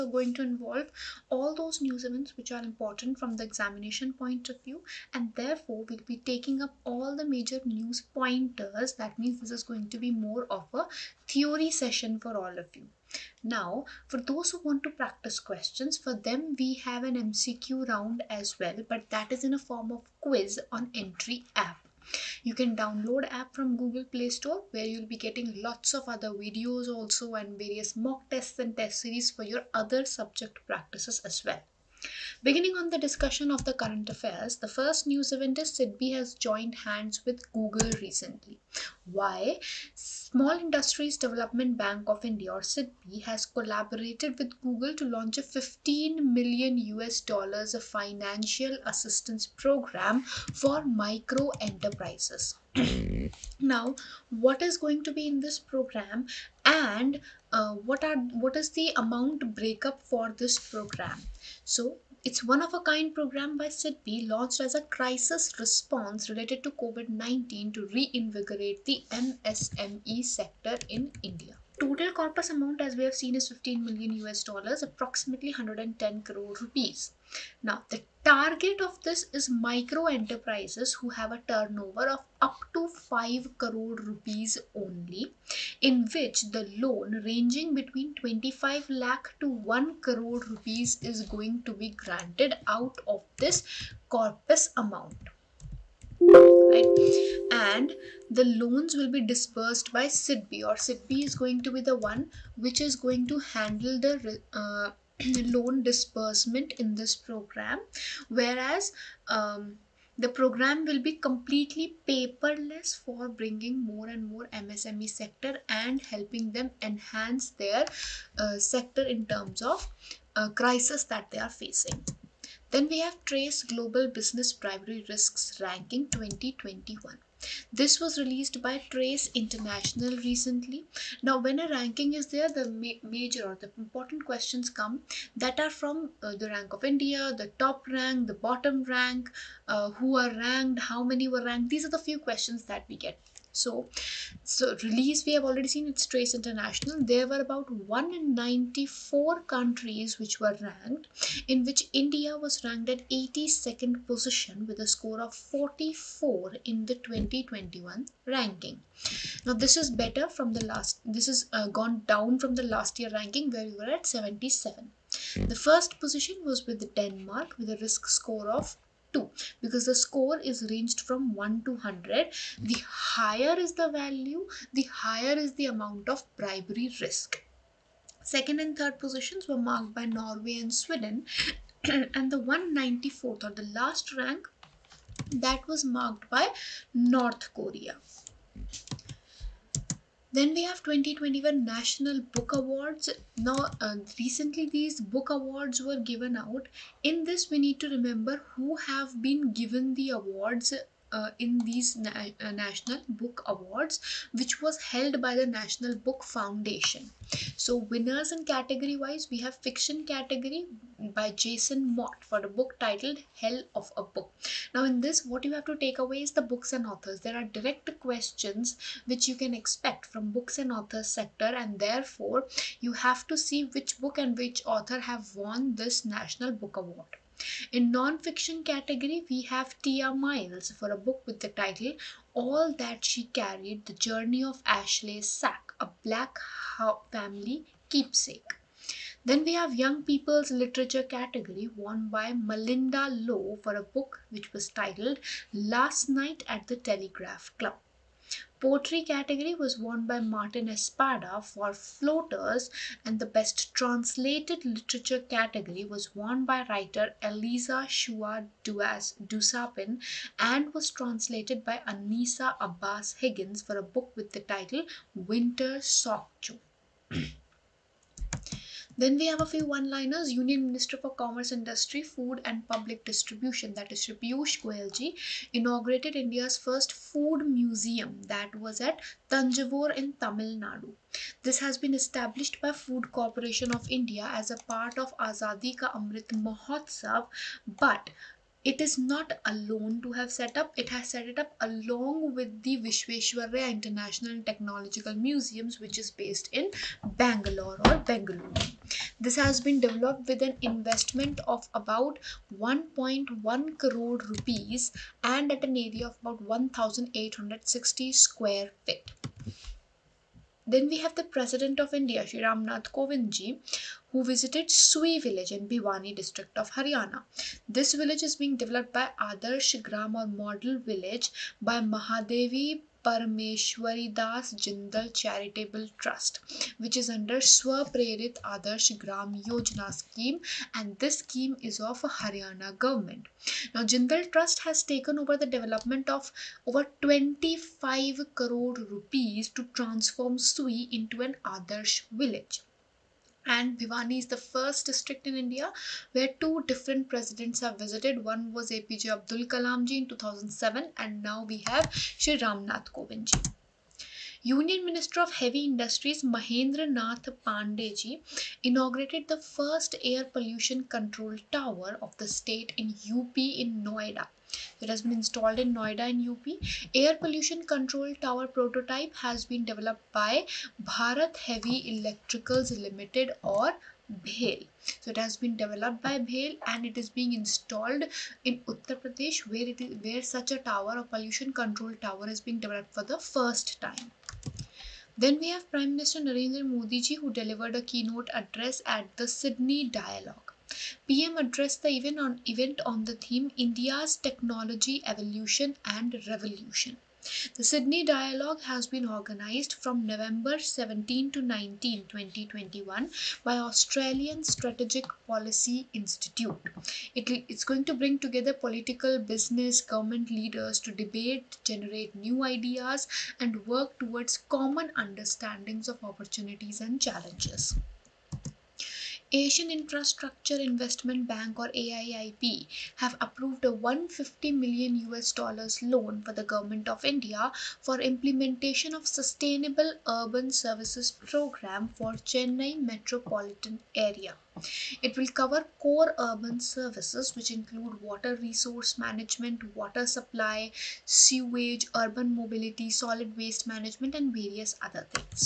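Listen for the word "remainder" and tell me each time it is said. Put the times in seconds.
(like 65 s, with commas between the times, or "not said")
not said.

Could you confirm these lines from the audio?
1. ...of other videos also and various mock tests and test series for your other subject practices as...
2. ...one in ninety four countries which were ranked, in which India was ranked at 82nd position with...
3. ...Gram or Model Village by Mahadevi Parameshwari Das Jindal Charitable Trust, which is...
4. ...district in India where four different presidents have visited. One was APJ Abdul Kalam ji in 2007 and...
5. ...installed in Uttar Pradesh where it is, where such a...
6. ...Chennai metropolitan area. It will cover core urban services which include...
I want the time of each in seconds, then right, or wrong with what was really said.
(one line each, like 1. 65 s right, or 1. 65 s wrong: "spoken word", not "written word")
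1. 25 s right
2. 147 s right
3. 319 s right
4. 344 s wrong: "two", not "four"
5. 377 s right
6. 432 s right.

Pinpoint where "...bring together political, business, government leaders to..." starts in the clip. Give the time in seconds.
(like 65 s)
407 s.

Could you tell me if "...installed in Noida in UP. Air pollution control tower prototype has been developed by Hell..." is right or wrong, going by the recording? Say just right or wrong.
wrong.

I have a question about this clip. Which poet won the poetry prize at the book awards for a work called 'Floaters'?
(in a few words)
Martin Espada.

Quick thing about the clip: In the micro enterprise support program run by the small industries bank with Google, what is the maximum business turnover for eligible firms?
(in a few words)
5 crore rupees.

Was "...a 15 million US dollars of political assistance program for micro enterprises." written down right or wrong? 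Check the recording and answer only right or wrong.
wrong.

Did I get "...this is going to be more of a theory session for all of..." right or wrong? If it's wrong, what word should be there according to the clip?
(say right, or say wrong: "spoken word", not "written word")
right.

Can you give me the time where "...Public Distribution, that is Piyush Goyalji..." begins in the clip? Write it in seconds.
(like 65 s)
272 s.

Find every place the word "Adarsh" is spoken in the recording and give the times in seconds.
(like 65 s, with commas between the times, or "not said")
319 s, 328 s, 341 s.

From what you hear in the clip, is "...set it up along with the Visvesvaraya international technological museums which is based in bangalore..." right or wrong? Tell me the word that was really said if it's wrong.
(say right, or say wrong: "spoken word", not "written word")
right.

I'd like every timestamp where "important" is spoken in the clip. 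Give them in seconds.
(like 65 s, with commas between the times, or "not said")
2 s, 133 s.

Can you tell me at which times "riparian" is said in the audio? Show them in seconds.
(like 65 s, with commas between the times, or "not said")
not said.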